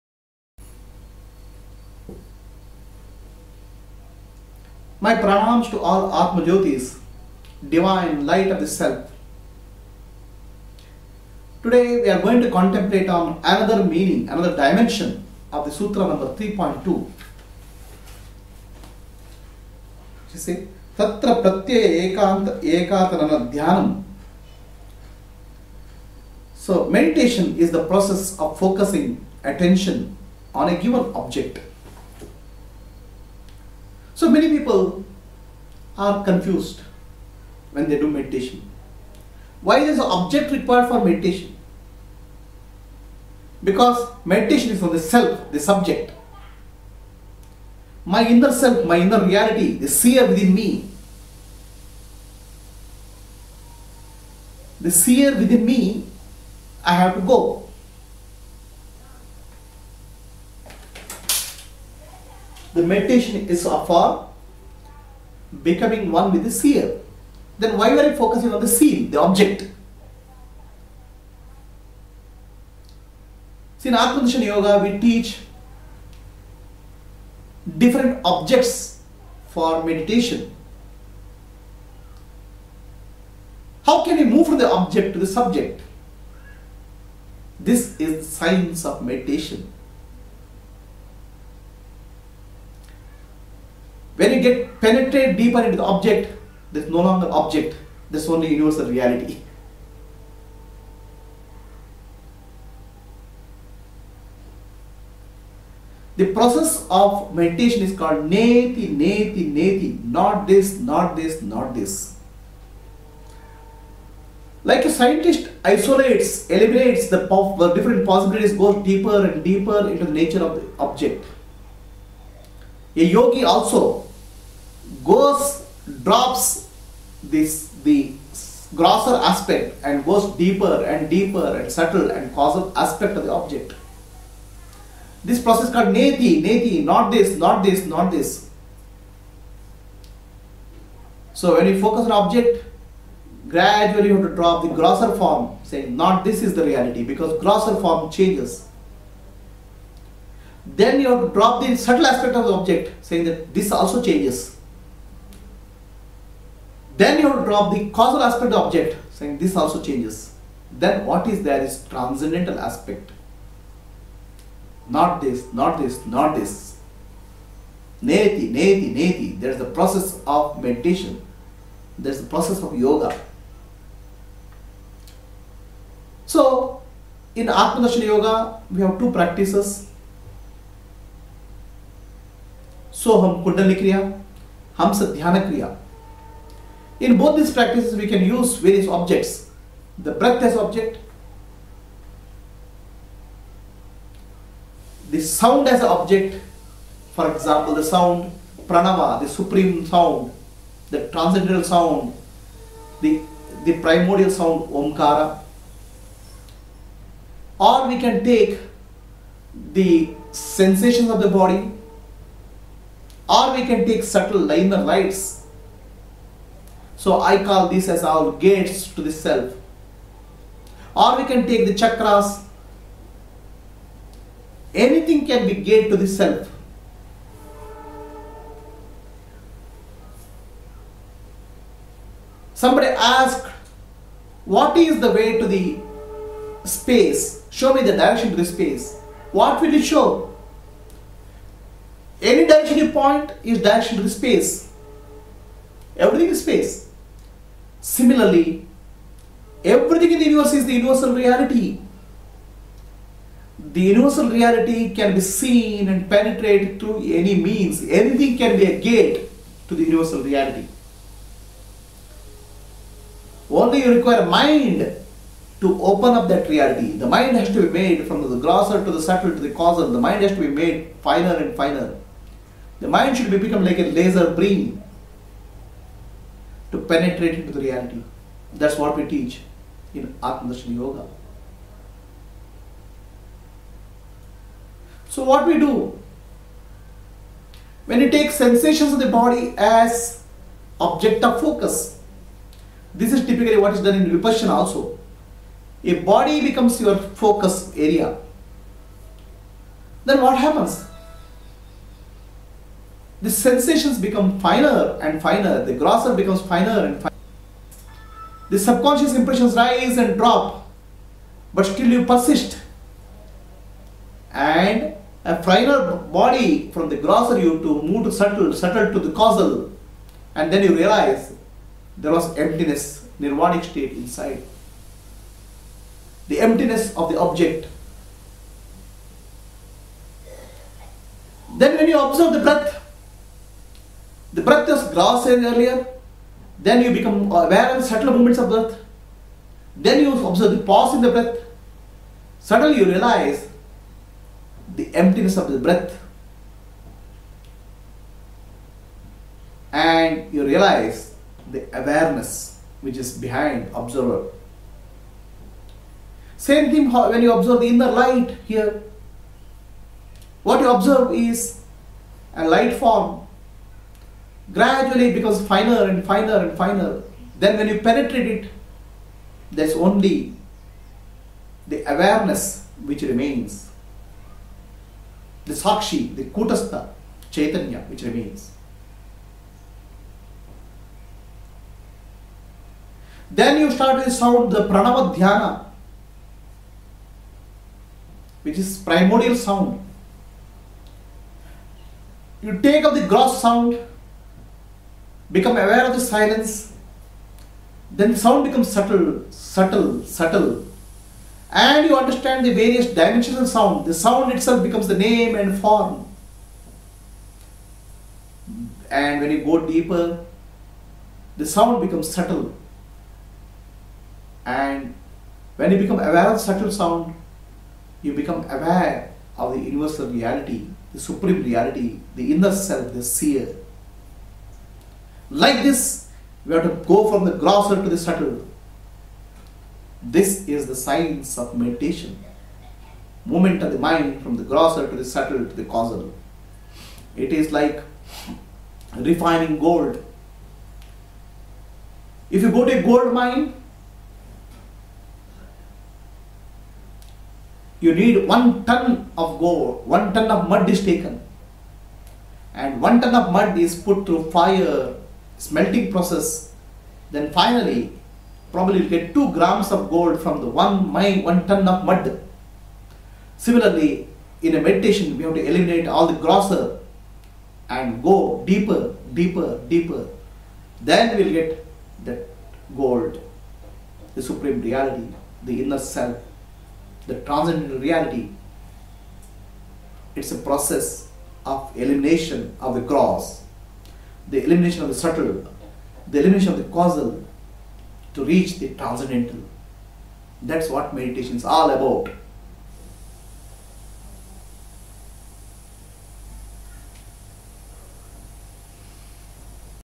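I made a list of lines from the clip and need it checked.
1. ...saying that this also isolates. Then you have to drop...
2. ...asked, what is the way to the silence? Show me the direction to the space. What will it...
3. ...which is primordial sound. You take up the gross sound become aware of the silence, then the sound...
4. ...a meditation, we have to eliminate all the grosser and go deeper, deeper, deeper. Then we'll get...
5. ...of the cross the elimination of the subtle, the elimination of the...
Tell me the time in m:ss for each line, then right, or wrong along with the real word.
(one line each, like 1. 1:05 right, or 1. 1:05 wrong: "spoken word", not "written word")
1. 2:33 wrong: "changes", not "isolates"
2. 3:52 wrong: "space", not "silence"
3. 6:28 right
4. 7:44 right
5. 8:02 right.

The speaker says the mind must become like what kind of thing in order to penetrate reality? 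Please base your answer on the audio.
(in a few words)
a laser beam.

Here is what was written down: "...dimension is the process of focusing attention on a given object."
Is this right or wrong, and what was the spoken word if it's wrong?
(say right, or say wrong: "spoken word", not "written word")
wrong: "meditation", not "dimension".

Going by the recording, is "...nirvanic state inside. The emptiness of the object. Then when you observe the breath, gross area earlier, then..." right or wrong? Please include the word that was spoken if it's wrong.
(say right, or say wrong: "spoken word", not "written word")
right.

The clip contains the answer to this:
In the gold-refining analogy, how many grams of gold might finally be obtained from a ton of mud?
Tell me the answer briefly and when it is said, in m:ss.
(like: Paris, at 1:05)
2 grams, at 7:39.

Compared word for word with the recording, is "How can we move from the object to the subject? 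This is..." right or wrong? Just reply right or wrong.
right.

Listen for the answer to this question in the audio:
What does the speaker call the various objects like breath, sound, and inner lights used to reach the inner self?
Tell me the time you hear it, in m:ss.
3:38.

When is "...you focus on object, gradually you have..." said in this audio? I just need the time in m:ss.
2:21.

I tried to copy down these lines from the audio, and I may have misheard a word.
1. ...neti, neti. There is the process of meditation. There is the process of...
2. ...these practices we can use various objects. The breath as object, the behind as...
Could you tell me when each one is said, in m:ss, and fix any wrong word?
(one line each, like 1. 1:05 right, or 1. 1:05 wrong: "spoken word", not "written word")
1. 2:48 right
2. 3:07 wrong: "sound", not "behind".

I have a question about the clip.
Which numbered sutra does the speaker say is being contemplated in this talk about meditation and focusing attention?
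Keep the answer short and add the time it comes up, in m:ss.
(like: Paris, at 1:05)
3.2, at 0:16.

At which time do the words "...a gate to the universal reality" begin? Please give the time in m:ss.
4:18.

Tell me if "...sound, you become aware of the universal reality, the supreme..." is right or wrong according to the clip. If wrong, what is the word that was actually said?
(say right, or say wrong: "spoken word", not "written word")
right.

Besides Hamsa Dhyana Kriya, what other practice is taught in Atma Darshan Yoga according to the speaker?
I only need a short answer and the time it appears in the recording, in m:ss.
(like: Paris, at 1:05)
So Soham Kundalini Kriya, at 3:03.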